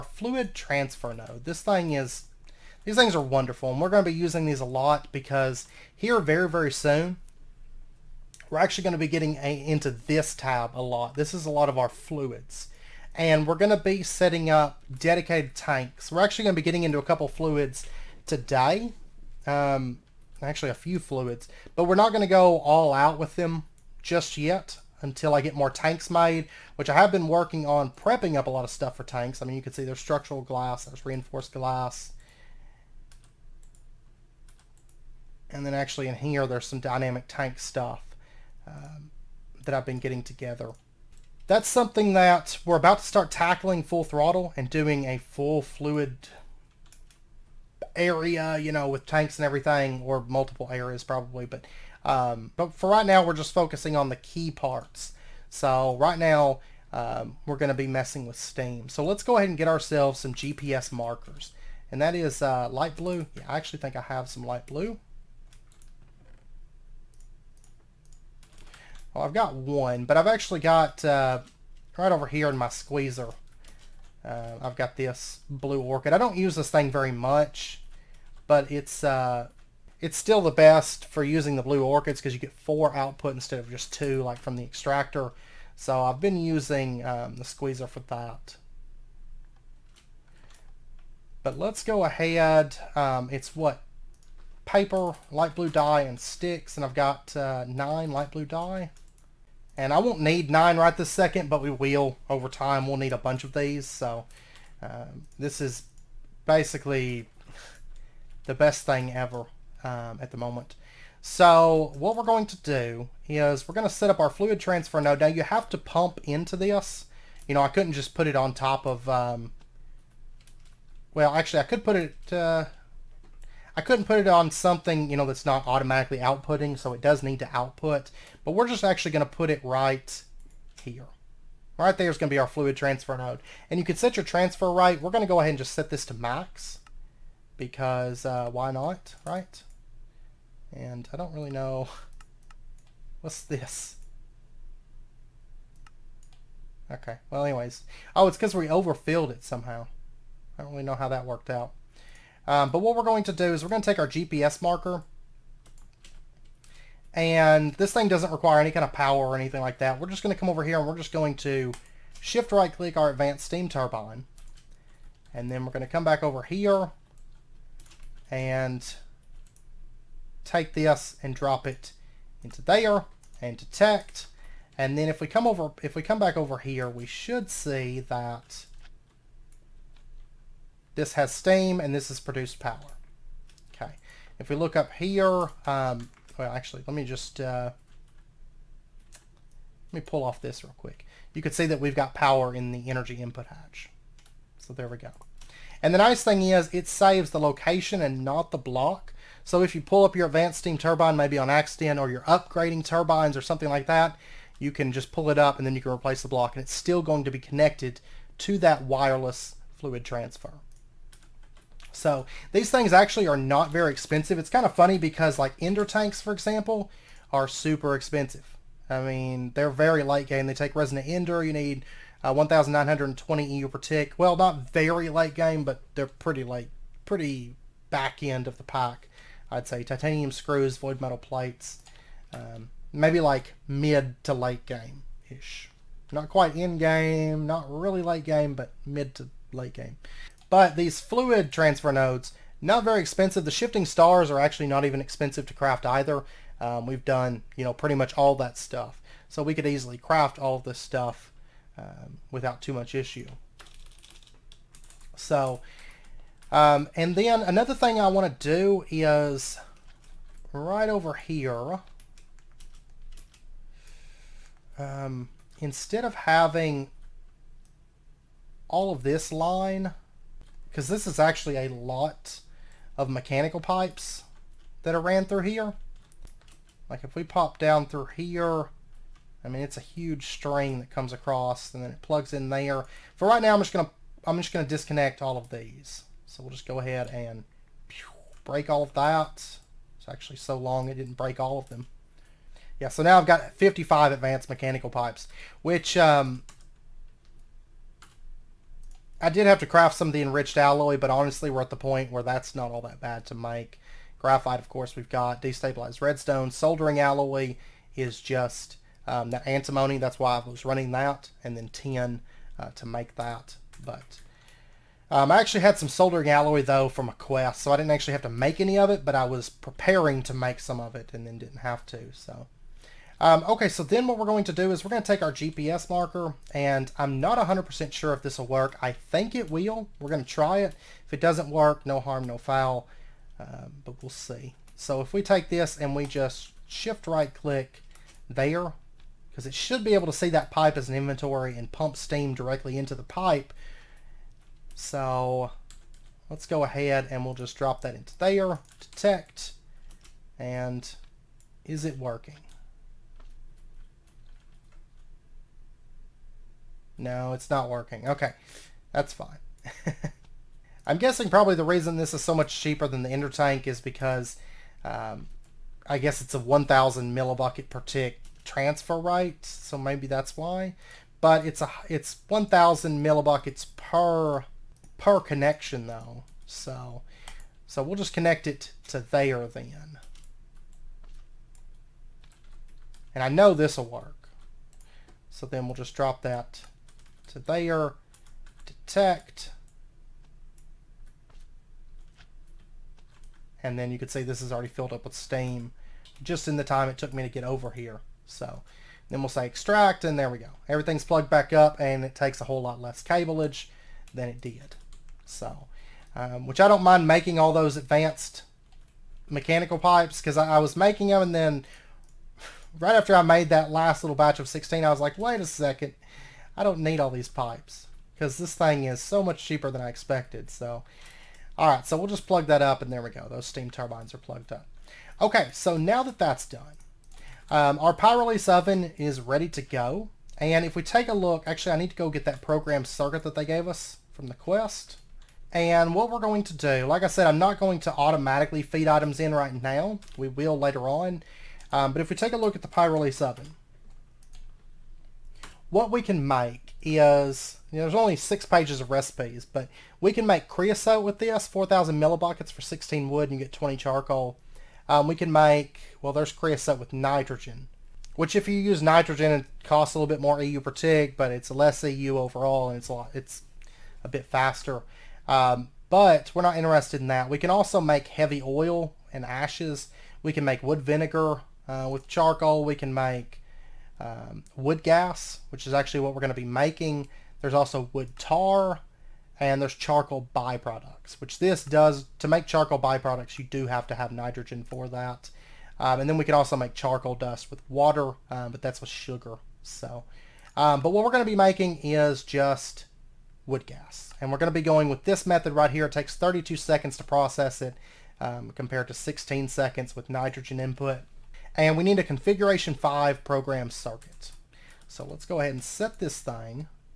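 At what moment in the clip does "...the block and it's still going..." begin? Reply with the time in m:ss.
3:26.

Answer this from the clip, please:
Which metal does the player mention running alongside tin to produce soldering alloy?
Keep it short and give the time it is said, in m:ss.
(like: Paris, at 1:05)
antimony, at 5:09.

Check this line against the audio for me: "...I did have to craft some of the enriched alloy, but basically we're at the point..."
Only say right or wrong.
wrong.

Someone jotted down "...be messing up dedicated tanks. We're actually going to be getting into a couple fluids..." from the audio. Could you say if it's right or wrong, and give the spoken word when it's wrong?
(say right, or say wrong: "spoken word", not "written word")
wrong: "setting", not "messing".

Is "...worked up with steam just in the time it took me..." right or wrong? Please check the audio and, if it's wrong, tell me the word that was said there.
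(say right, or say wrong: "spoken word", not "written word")
wrong: "filled", not "worked".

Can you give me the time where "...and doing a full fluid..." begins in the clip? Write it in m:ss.
0:44.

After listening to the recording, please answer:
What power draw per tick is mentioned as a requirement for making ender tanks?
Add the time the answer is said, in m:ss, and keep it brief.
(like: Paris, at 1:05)
1,920 EU, at 3:42.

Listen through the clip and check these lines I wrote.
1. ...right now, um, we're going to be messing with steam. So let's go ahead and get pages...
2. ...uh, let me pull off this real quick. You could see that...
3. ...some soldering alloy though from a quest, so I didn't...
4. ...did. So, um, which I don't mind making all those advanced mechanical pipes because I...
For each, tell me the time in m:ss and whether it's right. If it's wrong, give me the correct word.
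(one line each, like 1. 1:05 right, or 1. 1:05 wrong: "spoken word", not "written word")
1. 0:55 wrong: "ourselves", not "pages"
2. 3:07 right
3. 5:15 right
4. 6:44 right.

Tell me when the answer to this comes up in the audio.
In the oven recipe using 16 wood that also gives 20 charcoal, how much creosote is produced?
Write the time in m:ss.
7:31.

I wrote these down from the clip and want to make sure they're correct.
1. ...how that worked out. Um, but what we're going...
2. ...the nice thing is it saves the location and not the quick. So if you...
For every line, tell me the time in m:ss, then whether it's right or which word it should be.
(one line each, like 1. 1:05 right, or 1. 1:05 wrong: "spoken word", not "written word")
1. 2:30 right
2. 3:15 wrong: "block", not "quick".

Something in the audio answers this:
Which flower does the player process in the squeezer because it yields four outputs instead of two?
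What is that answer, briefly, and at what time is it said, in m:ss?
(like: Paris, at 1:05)
blue orchid, at 1:15.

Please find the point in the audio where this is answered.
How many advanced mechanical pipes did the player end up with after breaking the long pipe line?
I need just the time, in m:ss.
4:53.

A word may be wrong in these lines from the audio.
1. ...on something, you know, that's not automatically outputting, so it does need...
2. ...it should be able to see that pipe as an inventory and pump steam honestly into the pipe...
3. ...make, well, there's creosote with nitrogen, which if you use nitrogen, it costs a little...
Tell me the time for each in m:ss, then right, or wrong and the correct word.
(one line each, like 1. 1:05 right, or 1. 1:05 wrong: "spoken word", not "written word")
1. 2:04 right
2. 5:39 wrong: "directly", not "honestly"
3. 7:35 right.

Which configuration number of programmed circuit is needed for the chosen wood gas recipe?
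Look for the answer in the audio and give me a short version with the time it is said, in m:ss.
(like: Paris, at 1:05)
5, at 8:22.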